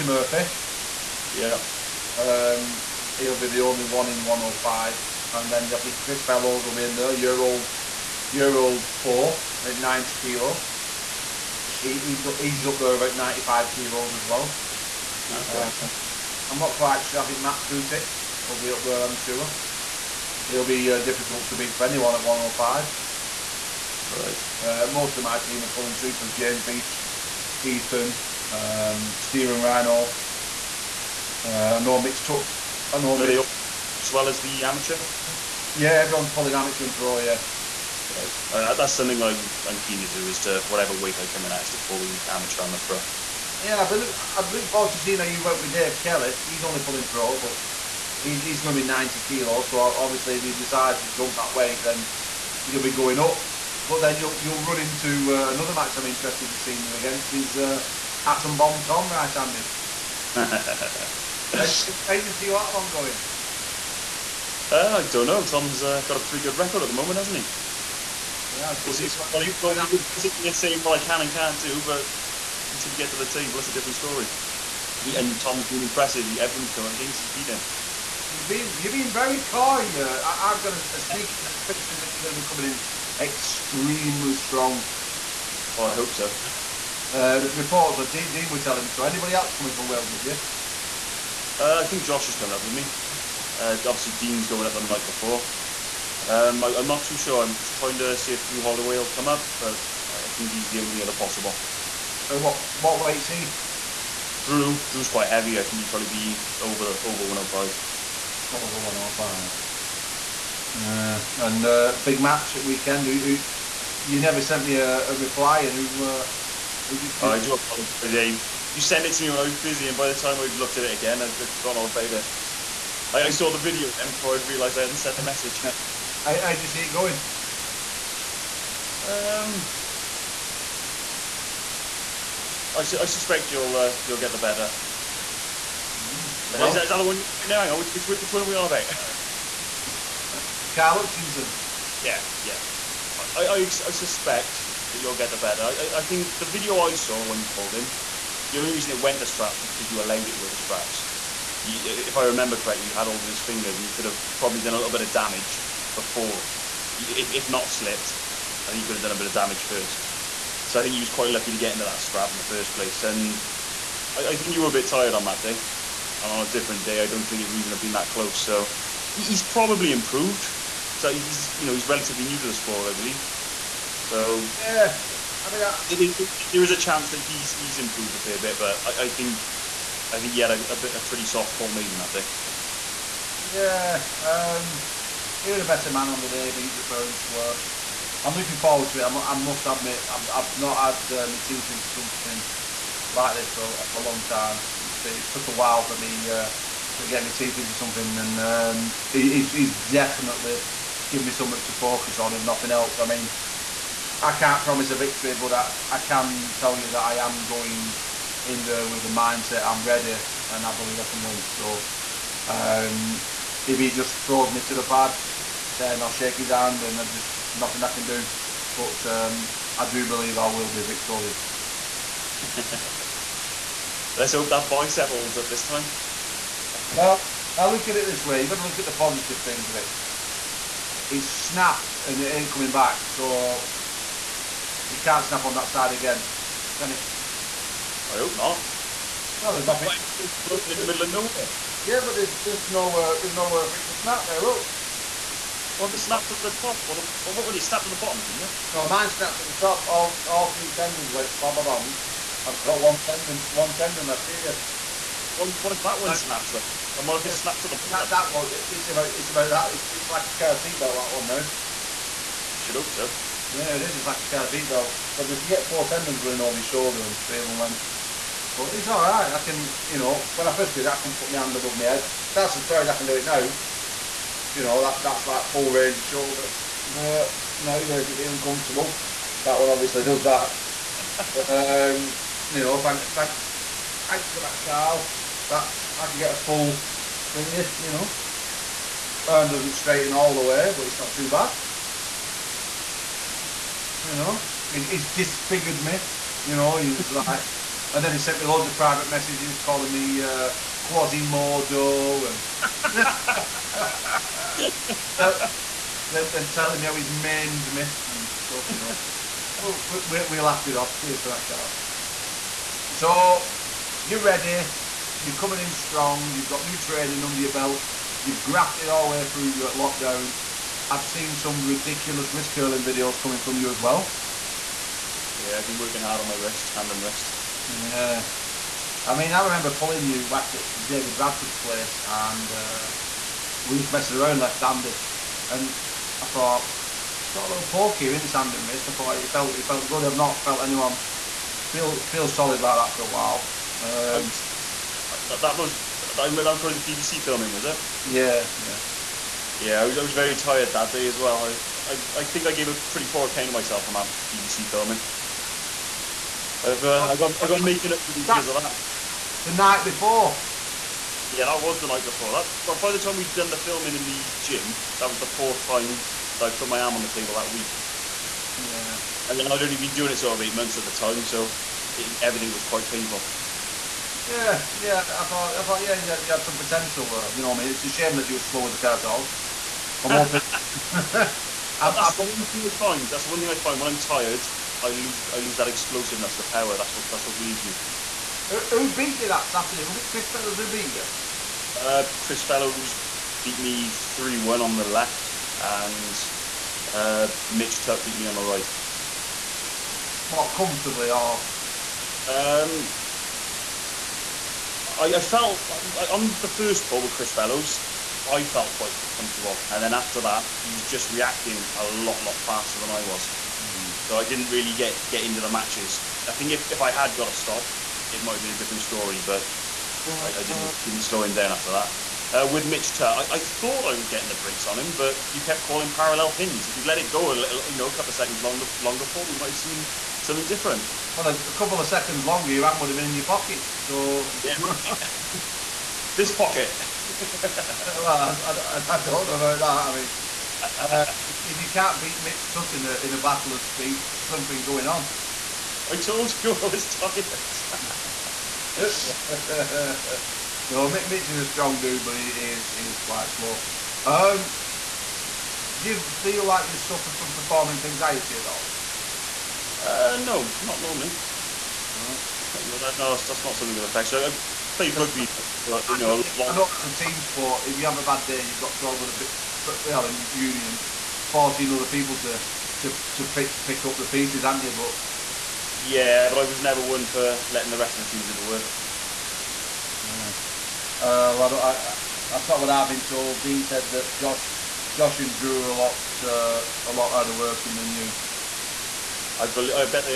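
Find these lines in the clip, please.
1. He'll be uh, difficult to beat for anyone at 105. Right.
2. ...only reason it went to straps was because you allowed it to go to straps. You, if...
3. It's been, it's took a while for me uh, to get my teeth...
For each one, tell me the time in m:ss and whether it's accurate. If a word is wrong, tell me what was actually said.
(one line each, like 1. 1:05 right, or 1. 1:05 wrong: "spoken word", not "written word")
1. 0:20 right
2. 2:28 right
3. 3:14 right.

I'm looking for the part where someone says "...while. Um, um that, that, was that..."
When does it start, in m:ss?
5:43.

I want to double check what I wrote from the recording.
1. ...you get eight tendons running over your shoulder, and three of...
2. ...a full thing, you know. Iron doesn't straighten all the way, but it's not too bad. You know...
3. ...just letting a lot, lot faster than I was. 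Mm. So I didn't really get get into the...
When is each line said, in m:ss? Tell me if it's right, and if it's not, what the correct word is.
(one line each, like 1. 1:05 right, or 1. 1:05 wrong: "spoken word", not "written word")
1. 4:25 wrong: "four", not "eight"
2. 4:46 right
3. 6:50 wrong: "reacting", not "letting".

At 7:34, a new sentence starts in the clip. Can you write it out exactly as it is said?
Um, do you feel like you suffer from performance anxiety at all?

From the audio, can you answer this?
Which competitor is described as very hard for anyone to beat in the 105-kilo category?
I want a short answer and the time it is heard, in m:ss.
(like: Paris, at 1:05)
Matt Putik, at 0:17.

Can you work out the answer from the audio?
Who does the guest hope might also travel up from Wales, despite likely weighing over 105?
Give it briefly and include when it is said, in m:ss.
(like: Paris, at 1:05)
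Drew Holloway, at 1:38.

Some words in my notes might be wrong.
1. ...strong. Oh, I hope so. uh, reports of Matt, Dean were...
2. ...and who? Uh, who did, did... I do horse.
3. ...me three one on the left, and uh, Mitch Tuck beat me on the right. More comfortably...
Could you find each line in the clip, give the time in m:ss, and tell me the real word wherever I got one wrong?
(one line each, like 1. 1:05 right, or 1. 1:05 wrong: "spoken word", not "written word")
1. 1:24 wrong: "Dean", not "Matt"
2. 1:55 wrong: "apologise", not "horse"
3. 6:33 right.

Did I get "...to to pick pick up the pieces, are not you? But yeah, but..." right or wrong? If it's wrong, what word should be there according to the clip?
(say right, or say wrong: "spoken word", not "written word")
right.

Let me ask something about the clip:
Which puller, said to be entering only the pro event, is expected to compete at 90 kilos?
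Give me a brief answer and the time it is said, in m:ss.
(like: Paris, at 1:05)
Dave Kelly, at 0:45.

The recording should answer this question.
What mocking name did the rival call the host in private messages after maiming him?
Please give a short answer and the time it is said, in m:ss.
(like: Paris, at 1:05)
Quasimodo, at 5:00.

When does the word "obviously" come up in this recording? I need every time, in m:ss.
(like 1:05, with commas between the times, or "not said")
0:49, 1:33, 4:39.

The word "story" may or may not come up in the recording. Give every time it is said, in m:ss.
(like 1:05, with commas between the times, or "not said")
1:13, 6:58.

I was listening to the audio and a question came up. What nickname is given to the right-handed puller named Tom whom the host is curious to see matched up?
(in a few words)
Atom Bomb Tom.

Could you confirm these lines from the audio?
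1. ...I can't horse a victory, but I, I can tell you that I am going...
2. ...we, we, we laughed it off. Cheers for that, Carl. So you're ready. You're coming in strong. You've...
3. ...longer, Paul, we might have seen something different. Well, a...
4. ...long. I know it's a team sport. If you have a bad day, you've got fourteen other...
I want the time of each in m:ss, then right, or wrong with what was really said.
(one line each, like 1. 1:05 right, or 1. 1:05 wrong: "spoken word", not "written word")
1. 3:24 wrong: "promise", not "horse"
2. 5:09 right
3. 7:08 right
4. 7:46 wrong: "twelve", not "fourteen".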